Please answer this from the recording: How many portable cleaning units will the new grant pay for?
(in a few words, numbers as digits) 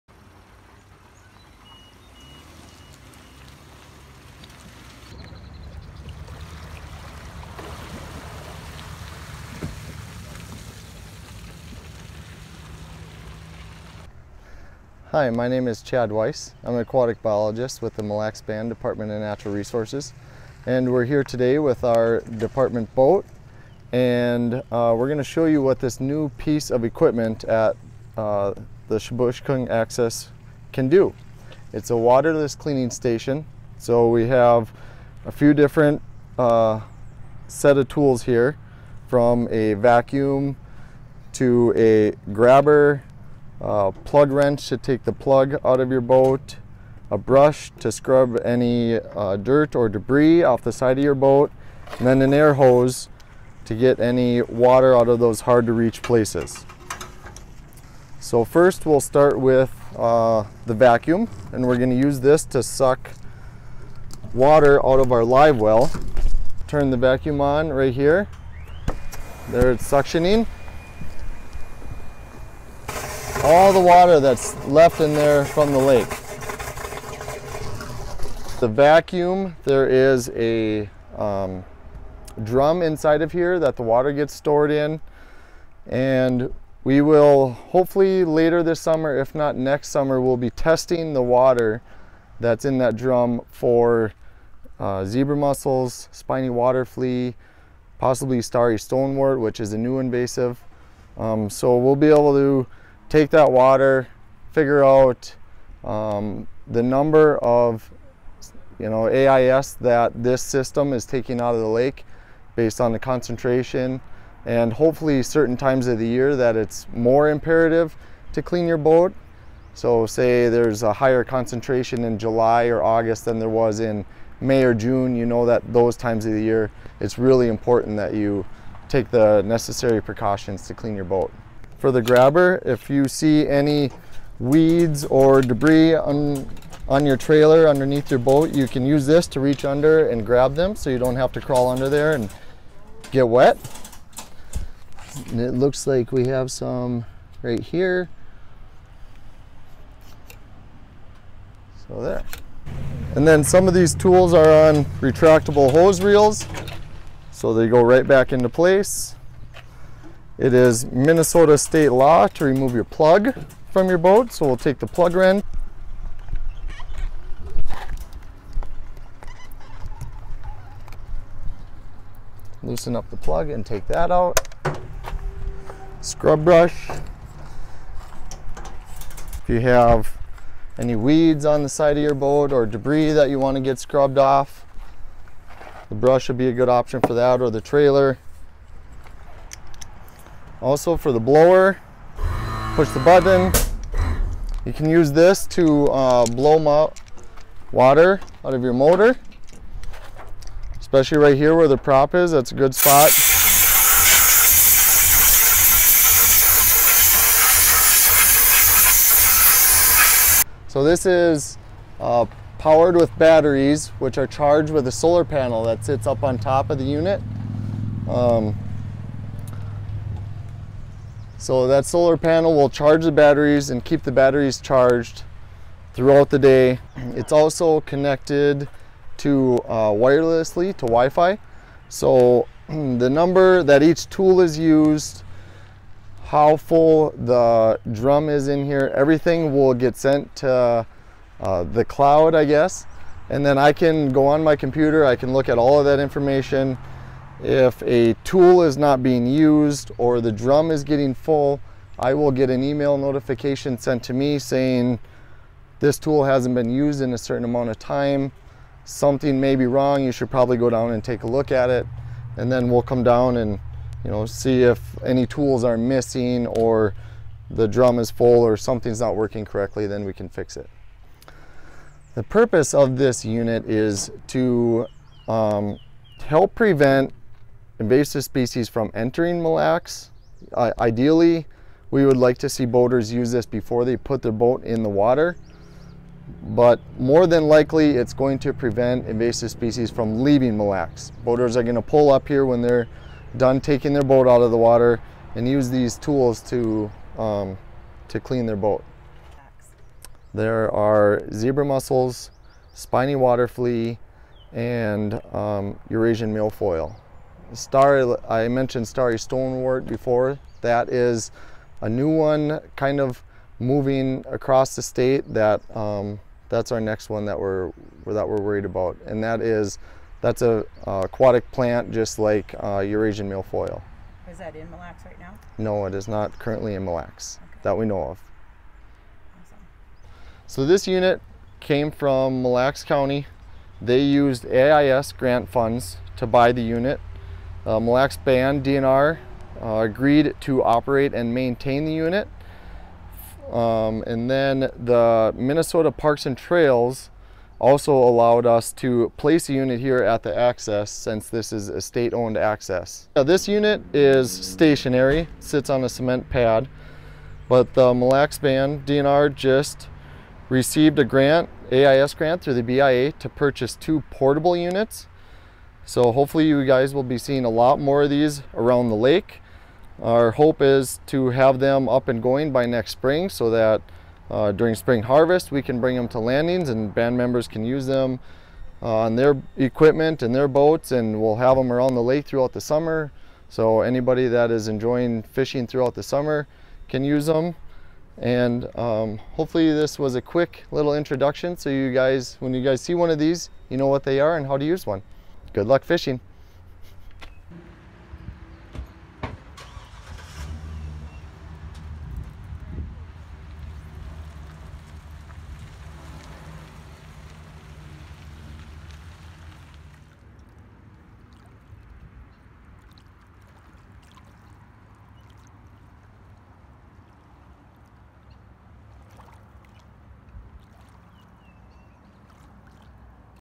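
2.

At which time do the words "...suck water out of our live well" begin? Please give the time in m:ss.
1:02.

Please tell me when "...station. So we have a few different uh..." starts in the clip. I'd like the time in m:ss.
0:32.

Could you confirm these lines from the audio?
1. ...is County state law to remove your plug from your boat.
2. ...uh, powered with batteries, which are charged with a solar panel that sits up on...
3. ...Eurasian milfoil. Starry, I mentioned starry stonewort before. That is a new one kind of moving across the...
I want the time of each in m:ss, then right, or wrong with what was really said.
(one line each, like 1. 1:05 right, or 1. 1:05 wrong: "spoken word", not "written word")
1. 2:40 wrong: "Minnesota", not "County"
2. 3:31 right
3. 5:05 right.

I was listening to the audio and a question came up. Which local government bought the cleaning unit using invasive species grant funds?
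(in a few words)
Mille Lacs County.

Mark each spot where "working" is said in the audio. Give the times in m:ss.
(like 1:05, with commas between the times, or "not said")
4:29.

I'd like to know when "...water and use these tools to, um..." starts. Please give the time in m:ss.
4:54.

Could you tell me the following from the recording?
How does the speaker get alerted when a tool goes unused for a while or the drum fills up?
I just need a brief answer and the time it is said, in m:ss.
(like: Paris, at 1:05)
Email notification, at 4:12.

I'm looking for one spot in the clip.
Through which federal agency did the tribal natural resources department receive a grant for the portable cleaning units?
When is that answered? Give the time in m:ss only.
6:02.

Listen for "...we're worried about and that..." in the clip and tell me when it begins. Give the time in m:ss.
5:18.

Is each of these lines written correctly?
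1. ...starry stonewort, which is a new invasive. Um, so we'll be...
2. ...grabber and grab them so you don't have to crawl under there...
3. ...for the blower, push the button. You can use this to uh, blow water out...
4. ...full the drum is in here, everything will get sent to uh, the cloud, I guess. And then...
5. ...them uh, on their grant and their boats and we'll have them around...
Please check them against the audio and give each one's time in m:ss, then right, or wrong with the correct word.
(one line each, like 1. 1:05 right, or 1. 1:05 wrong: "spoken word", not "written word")
1. 1:38 right
2. 2:19 wrong: "under", not "grabber"
3. 3:10 right
4. 3:56 right
5. 6:17 wrong: "equipment", not "grant".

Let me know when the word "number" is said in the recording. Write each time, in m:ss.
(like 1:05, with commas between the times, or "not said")
1:46, 3:53.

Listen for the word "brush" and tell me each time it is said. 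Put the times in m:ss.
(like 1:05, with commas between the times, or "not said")
0:47, 2:56, 3:05.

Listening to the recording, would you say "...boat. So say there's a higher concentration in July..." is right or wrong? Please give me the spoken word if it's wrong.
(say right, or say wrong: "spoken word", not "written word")
right.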